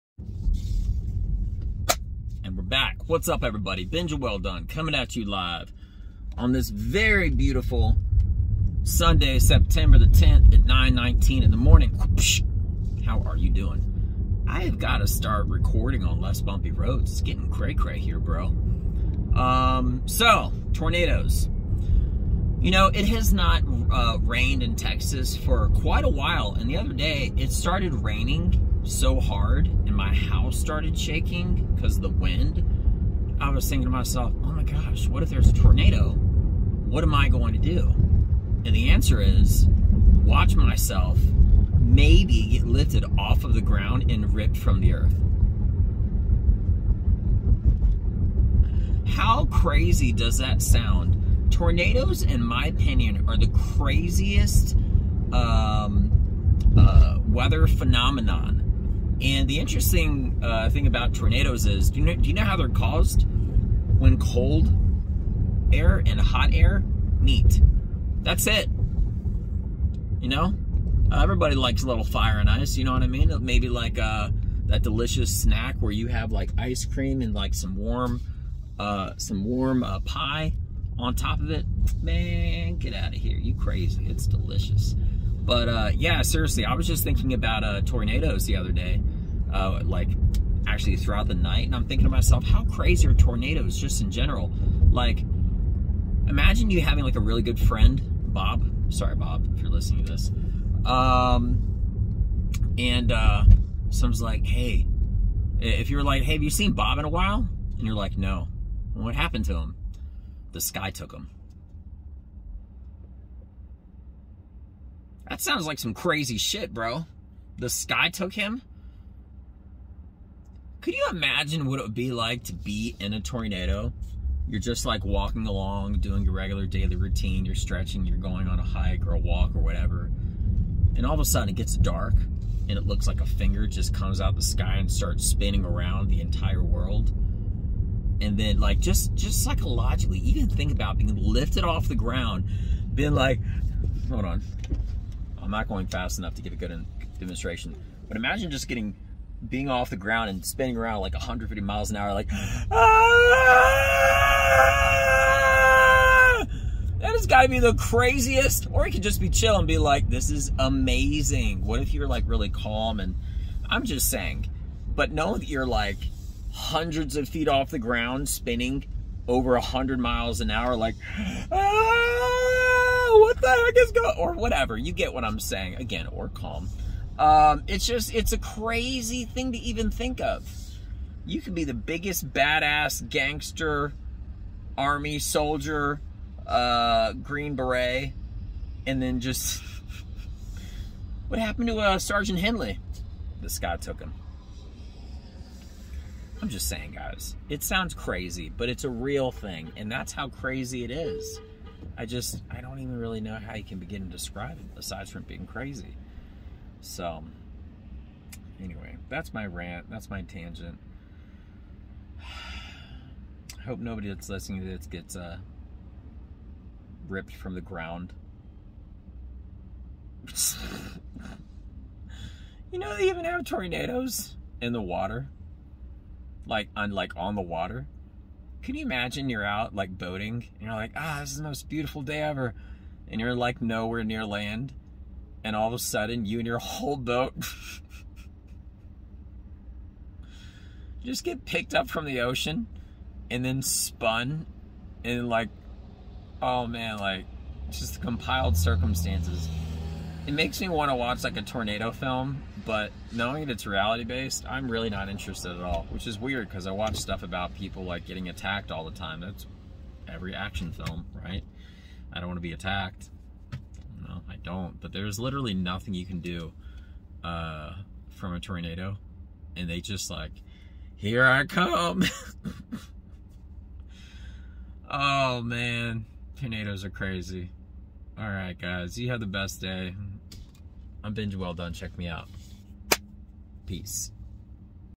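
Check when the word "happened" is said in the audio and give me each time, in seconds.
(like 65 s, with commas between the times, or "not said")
109 s, 191 s.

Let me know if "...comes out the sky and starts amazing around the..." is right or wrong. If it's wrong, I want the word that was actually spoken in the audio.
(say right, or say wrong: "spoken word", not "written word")
wrong: "spinning", not "amazing".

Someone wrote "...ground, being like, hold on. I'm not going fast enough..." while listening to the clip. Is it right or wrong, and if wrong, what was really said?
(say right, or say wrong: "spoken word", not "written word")
right.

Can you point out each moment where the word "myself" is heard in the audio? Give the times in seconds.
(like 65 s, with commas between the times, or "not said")
33 s, 40 s, 92 s.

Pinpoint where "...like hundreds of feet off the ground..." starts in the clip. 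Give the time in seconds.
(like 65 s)
165 s.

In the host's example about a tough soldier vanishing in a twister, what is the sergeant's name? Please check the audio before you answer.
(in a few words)
Henley.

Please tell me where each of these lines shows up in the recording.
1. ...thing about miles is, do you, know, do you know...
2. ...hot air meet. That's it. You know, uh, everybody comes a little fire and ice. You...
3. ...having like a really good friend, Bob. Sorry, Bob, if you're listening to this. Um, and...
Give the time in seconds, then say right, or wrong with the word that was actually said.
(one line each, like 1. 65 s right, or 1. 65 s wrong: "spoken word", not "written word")
1. 60 s wrong: "tornadoes", not "miles"
2. 66 s wrong: "likes", not "comes"
3. 96 s right.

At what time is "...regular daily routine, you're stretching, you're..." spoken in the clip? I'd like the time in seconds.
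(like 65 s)
126 s.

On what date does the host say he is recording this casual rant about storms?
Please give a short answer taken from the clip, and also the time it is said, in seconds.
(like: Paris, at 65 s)
Sunday, September 10, at 8 s.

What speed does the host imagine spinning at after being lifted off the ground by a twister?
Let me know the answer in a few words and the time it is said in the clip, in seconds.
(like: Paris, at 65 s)
150 miles an hour, at 151 s.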